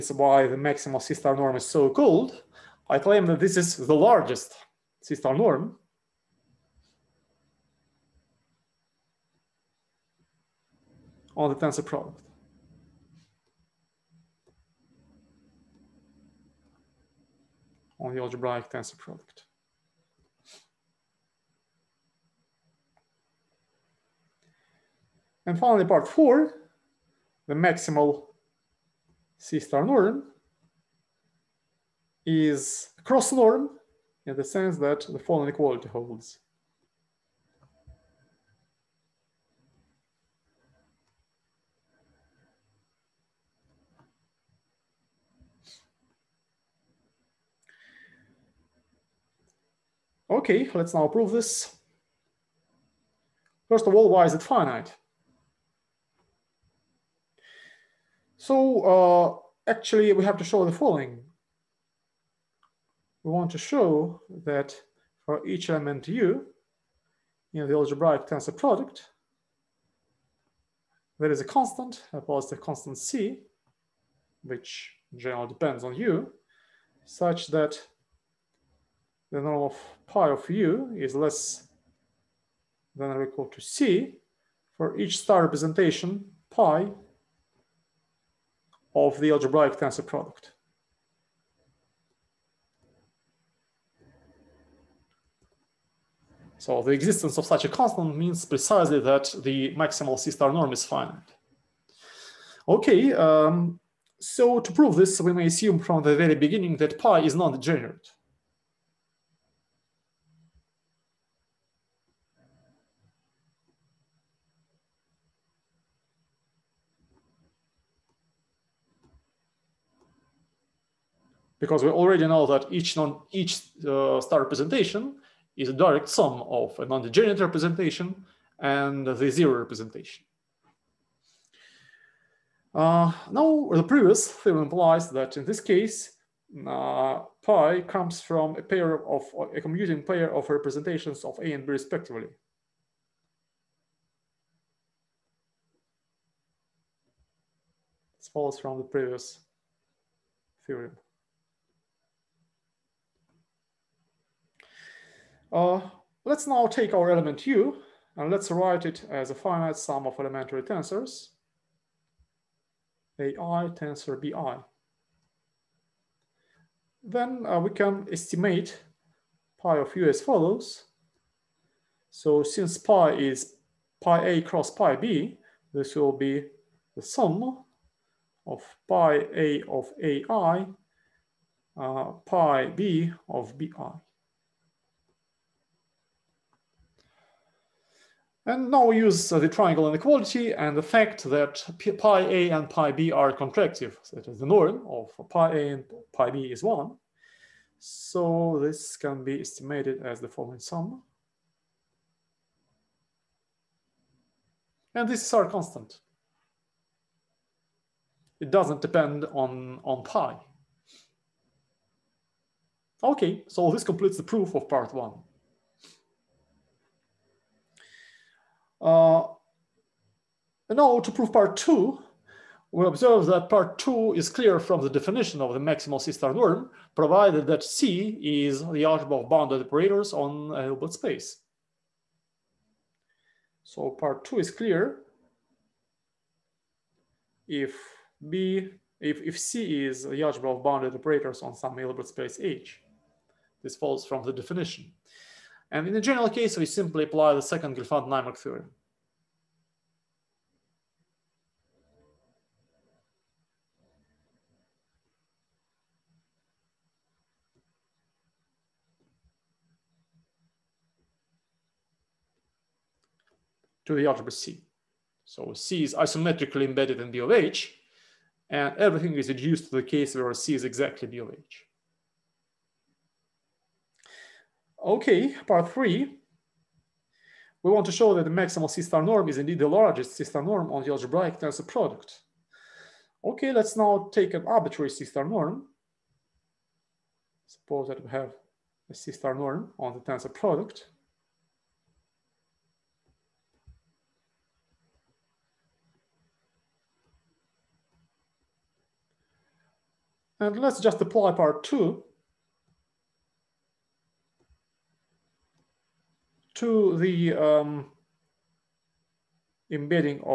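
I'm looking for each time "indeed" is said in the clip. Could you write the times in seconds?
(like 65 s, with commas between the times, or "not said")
279 s.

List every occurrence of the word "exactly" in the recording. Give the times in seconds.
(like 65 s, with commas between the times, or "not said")
270 s.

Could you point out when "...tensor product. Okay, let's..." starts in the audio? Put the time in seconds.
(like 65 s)
281 s.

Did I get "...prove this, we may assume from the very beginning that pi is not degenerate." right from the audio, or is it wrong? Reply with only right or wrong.
right.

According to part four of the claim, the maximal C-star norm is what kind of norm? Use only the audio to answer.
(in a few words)
Cross norm.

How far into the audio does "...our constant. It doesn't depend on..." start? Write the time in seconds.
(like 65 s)
205 s.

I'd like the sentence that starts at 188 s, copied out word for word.
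And now we use the triangle inequality and the fact that pi a and pi b are contractive.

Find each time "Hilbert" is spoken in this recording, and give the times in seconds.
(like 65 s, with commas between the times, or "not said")
230 s, 241 s.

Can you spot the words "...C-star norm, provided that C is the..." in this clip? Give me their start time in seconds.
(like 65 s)
225 s.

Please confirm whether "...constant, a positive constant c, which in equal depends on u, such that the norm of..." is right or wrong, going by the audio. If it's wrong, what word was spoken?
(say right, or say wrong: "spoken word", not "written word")
wrong: "general", not "equal".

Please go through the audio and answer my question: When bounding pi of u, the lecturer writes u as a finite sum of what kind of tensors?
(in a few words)
Elementary tensors.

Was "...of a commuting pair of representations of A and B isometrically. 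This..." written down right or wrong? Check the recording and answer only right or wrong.
wrong.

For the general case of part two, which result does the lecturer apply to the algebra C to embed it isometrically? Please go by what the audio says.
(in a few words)
Second Gelfand-Naimark theorem.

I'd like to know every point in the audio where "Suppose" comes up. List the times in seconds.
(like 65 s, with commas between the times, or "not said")
287 s.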